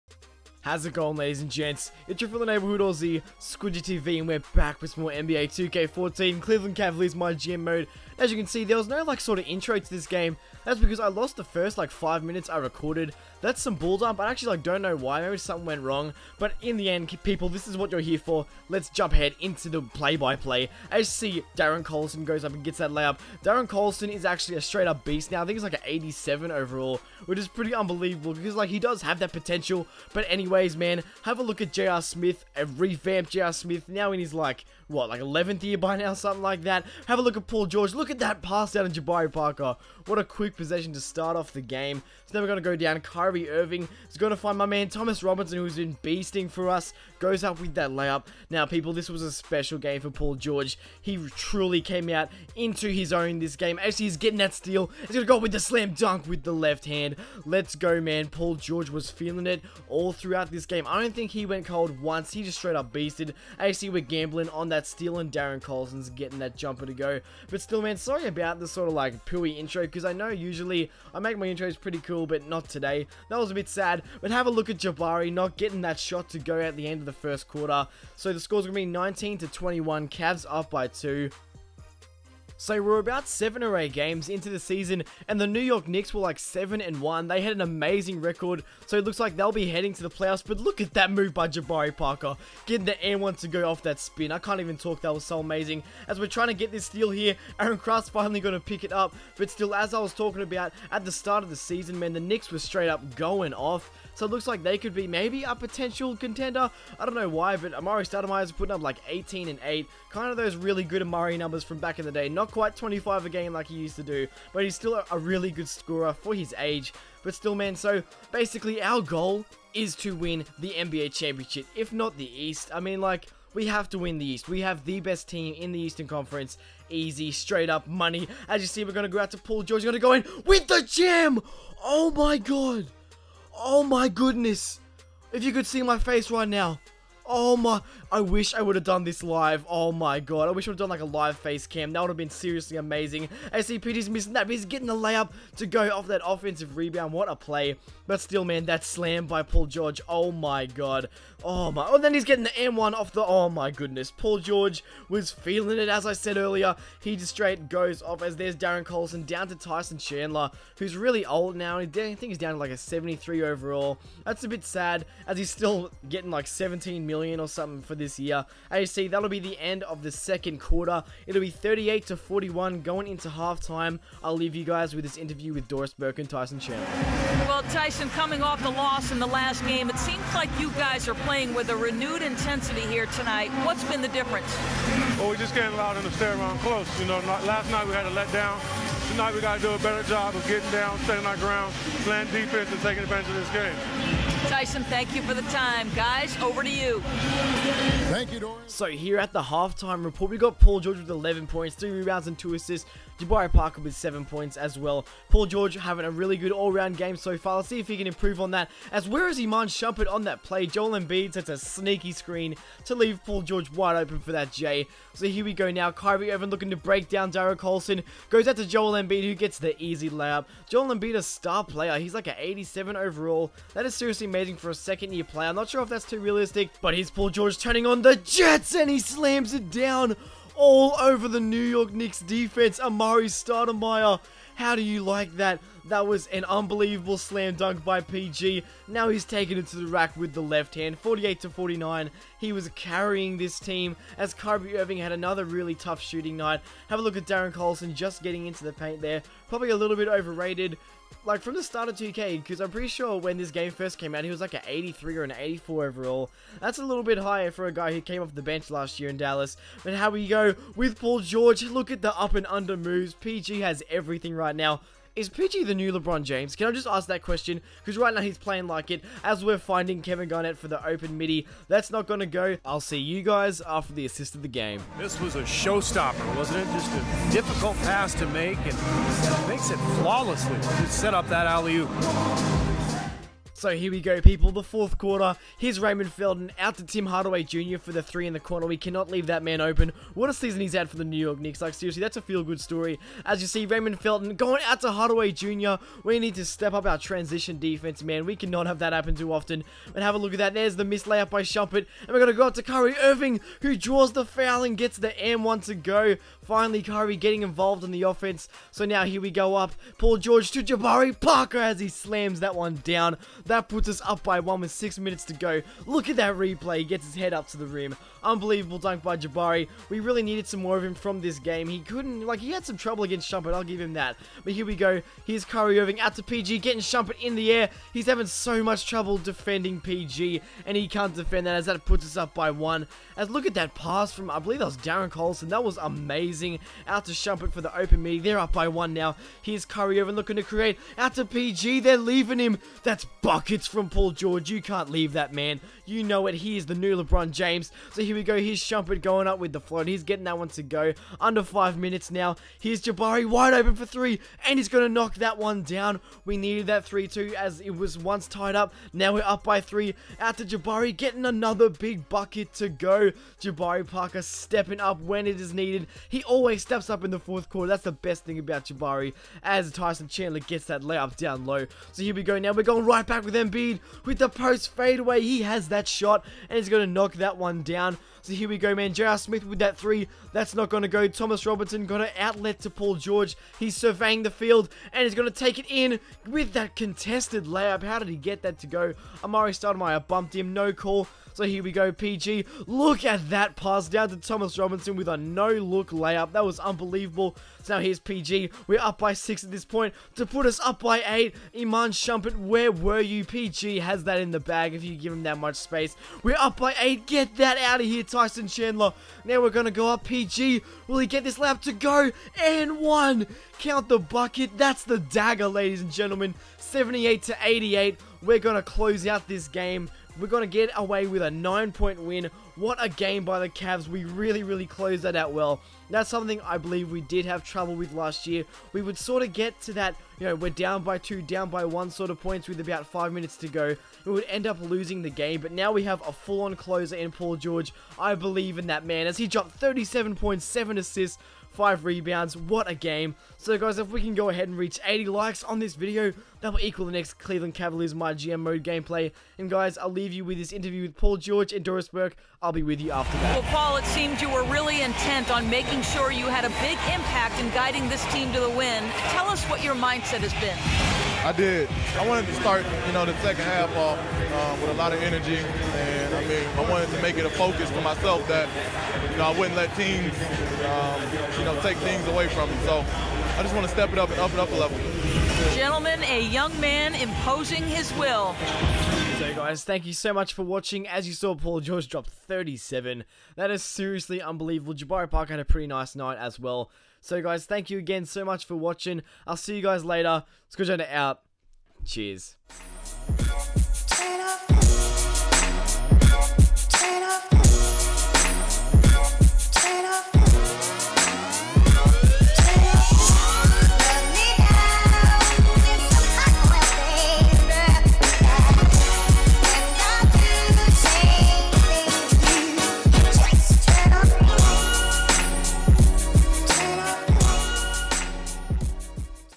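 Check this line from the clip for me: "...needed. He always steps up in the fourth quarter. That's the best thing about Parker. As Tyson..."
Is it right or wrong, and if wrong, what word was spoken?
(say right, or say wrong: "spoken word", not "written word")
wrong: "Jabari", not "Parker".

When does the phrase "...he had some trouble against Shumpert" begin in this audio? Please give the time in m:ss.
5:22.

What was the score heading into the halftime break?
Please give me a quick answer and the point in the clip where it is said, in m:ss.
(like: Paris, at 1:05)
38 to 41, at 2:51.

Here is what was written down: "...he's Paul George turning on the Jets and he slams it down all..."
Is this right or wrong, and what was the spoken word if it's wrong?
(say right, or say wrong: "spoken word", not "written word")
right.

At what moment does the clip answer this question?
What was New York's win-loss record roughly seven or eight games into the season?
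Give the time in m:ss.
1:26.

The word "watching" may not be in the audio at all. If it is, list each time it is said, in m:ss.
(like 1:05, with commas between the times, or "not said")
8:00, 8:08.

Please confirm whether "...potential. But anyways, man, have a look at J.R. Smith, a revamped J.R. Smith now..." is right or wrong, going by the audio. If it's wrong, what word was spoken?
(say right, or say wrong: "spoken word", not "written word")
right.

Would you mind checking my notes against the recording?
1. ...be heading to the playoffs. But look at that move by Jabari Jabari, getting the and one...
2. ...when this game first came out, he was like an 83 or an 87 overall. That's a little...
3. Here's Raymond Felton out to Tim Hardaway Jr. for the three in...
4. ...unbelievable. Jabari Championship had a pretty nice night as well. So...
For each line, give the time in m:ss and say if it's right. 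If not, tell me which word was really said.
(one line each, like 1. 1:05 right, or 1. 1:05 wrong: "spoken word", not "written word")
1. 1:29 wrong: "Parker", not "Jabari"
2. 4:13 wrong: "84", not "87"
3. 4:45 right
4. 8:04 wrong: "Park", not "Championship".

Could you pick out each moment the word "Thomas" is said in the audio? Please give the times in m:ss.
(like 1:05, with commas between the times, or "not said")
0:44, 6:21, 6:34.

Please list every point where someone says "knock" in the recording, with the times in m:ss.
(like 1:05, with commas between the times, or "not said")
5:54, 6:16.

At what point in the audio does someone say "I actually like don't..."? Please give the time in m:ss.
0:14.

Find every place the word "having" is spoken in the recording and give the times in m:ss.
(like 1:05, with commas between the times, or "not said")
3:25, 5:28.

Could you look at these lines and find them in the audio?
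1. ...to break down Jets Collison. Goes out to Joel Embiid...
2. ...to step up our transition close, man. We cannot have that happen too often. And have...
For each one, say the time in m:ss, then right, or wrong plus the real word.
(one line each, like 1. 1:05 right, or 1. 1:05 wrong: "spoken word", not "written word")
1. 3:36 wrong: "Derek", not "Jets"
2. 4:56 wrong: "defense", not "close".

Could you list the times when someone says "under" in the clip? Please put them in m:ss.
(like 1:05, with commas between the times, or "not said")
4:22, 5:51.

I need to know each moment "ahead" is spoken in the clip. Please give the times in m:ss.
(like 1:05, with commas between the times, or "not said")
0:19, 7:24.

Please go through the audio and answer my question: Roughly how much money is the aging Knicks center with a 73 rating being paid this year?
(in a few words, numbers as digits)
17 million.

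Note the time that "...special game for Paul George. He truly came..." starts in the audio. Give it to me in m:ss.
0:49.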